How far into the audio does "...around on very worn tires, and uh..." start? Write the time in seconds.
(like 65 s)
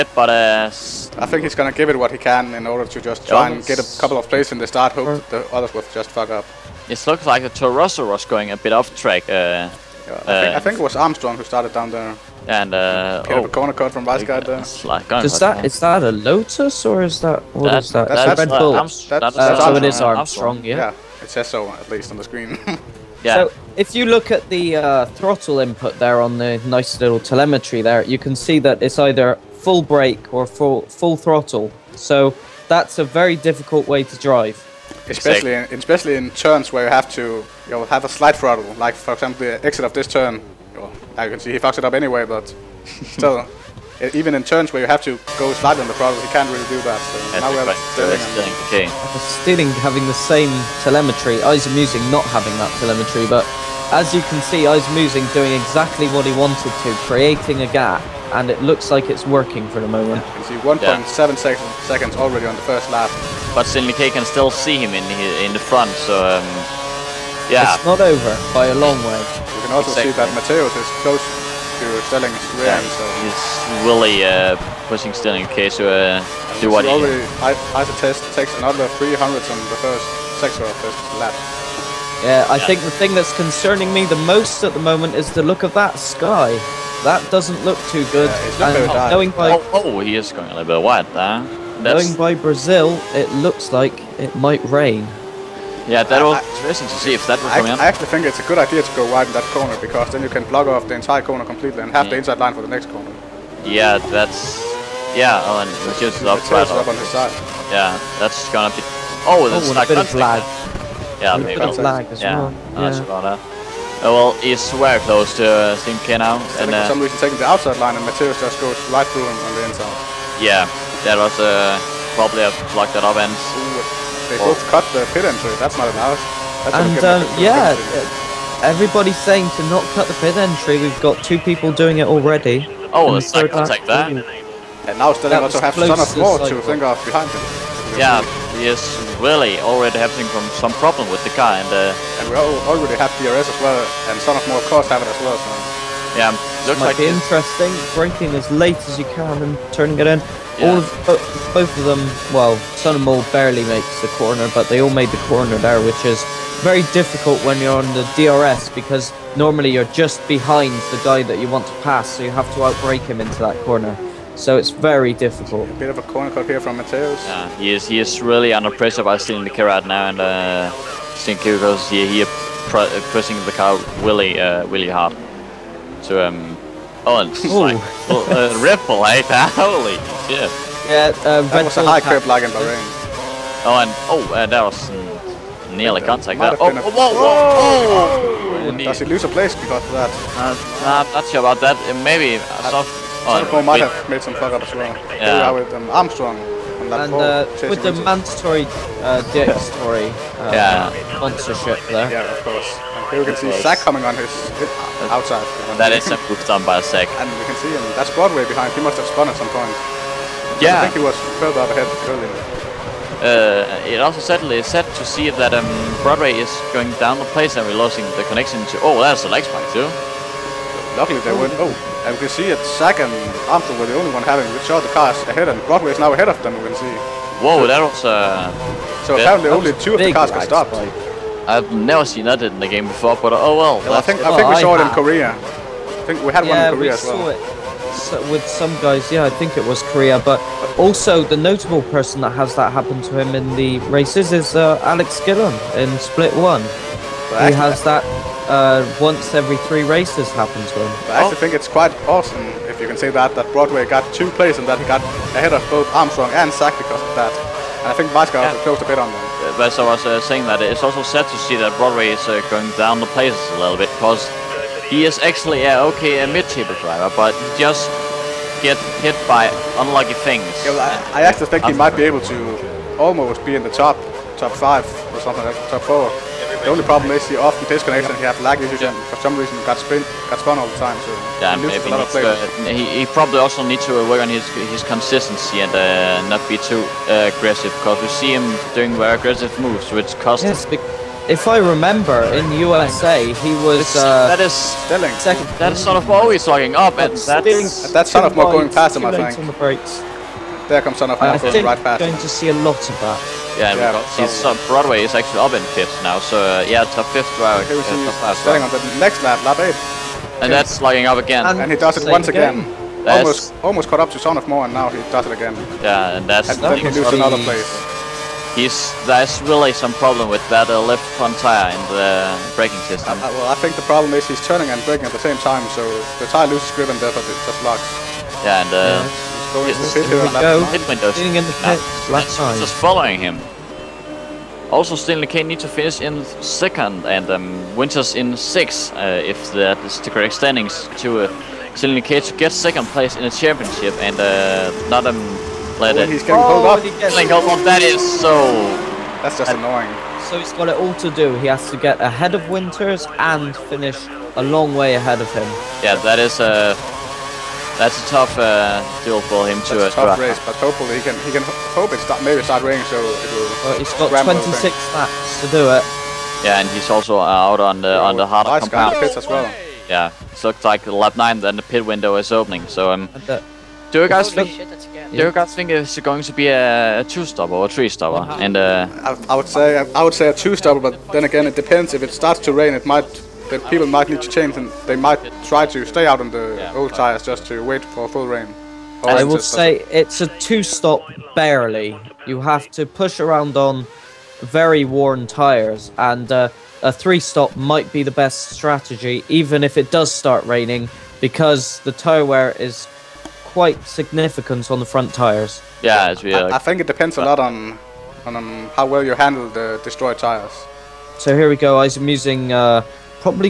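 393 s.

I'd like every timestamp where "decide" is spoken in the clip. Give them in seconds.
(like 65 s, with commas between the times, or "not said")
not said.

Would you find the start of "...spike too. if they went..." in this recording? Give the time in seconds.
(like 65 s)
219 s.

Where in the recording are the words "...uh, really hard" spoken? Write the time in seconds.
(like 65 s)
174 s.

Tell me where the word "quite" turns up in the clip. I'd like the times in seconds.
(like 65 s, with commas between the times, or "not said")
251 s, 403 s.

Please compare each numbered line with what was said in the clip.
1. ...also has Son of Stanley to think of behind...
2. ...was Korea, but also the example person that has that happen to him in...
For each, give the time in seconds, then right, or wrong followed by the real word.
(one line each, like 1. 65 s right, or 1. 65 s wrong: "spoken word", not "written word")
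1. 135 s wrong: "War", not "Stanley"
2. 239 s wrong: "notable", not "example".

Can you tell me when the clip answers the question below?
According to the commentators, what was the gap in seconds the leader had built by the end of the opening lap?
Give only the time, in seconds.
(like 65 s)
60 s.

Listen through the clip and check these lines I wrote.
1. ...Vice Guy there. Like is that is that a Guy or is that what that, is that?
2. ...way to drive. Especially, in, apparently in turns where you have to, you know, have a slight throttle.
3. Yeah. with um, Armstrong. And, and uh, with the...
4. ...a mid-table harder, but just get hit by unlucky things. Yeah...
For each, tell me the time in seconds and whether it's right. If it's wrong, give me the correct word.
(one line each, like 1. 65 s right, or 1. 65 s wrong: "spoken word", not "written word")
1. 14 s wrong: "Lotus", not "Guy"
2. 33 s wrong: "especially", not "apparently"
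3. 195 s right
4. 266 s wrong: "driver", not "harder".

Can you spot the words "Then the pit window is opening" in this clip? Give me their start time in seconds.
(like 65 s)
371 s.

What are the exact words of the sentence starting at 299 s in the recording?
On the there comes Son of I think right past.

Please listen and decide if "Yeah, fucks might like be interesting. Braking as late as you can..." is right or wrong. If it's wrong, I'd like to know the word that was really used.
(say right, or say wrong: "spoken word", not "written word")
wrong: "looks", not "fucks".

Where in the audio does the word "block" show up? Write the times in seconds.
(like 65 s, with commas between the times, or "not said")
100 s, 122 s.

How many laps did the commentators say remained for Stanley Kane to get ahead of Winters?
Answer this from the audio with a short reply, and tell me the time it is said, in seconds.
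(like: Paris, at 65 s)
26, at 364 s.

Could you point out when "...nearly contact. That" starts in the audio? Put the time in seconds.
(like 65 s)
185 s.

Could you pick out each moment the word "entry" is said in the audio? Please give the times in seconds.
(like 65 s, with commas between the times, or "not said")
125 s, 130 s.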